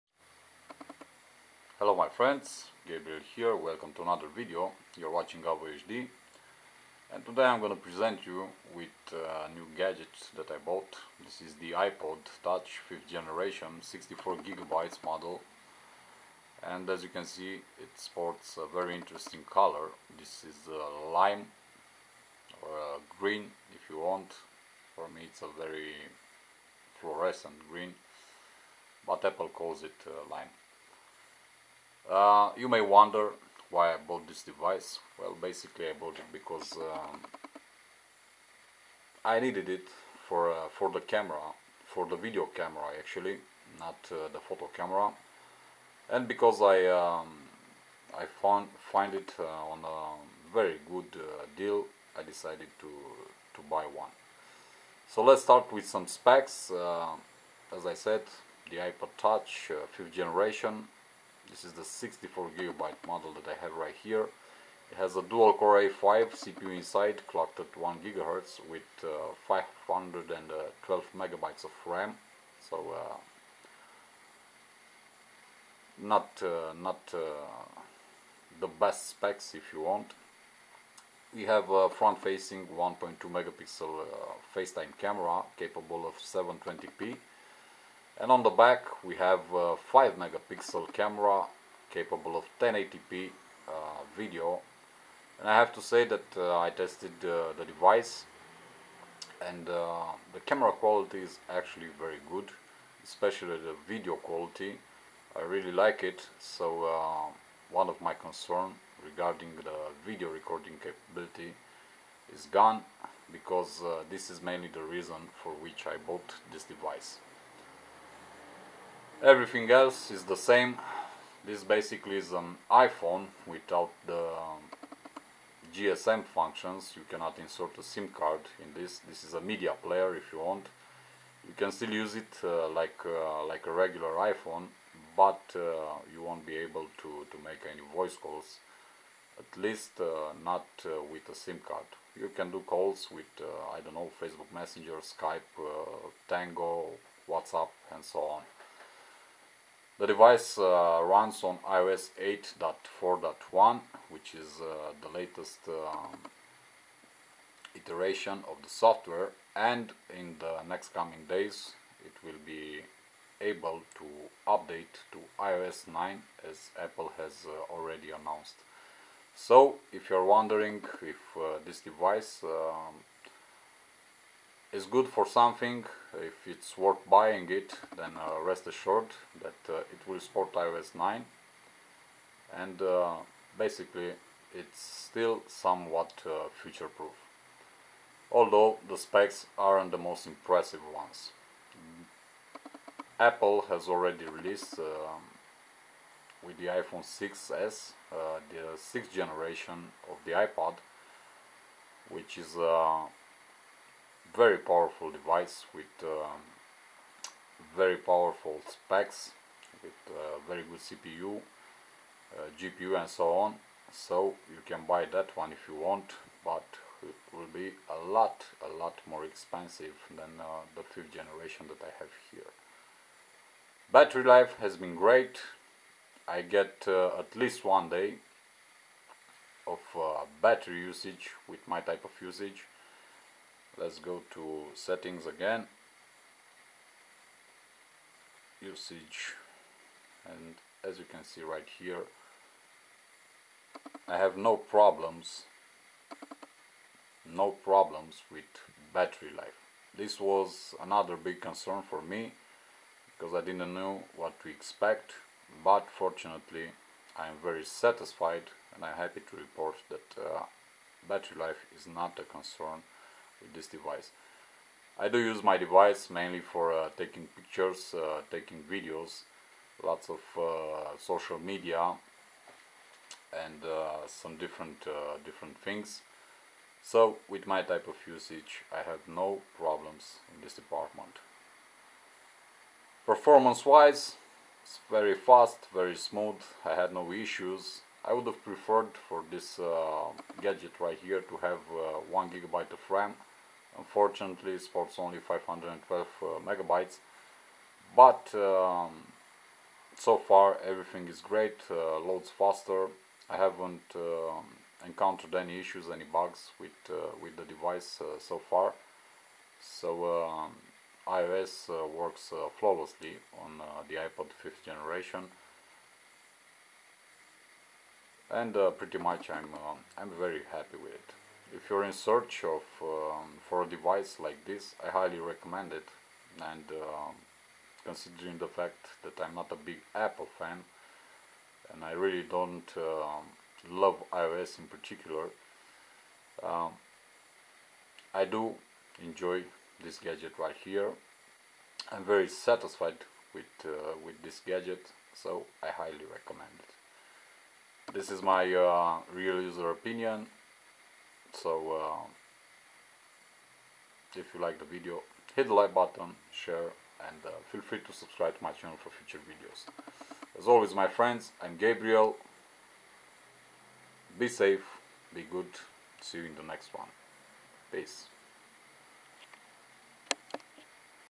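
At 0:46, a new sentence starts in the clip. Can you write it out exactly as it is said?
And because I, um, I found, find it uh, on a very good uh, deal, I decided to, to buy one.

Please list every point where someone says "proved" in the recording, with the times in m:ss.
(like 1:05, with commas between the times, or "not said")
not said.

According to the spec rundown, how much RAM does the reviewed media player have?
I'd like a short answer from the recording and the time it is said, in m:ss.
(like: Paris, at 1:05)
512 MB, at 1:09.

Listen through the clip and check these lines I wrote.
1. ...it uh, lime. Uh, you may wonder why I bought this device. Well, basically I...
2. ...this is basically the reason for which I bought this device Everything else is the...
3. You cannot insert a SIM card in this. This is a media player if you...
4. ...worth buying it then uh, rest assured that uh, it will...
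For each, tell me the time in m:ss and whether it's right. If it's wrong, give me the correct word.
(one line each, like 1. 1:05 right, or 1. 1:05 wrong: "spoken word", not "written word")
1. 0:29 right
2. 1:54 wrong: "mainly", not "basically"
3. 2:06 right
4. 2:56 right.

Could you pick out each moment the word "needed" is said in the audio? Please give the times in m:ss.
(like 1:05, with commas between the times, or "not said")
0:39.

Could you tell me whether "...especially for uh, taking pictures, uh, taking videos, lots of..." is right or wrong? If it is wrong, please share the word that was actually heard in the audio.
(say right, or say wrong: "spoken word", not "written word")
wrong: "mainly", not "especially".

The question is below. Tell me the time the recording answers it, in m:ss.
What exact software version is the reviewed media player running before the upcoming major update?
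2:31.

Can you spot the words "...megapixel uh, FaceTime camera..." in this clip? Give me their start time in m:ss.
1:23.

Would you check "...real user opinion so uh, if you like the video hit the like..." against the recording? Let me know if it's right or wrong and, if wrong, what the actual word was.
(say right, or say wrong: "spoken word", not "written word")
right.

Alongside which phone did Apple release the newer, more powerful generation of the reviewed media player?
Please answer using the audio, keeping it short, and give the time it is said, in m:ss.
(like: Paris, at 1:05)
iPhone 6s, at 3:16.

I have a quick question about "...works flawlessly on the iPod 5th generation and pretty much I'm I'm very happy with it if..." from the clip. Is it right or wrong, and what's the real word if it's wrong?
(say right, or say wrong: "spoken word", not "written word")
right.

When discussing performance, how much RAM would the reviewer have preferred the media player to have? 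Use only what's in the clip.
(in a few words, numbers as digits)
1 GB.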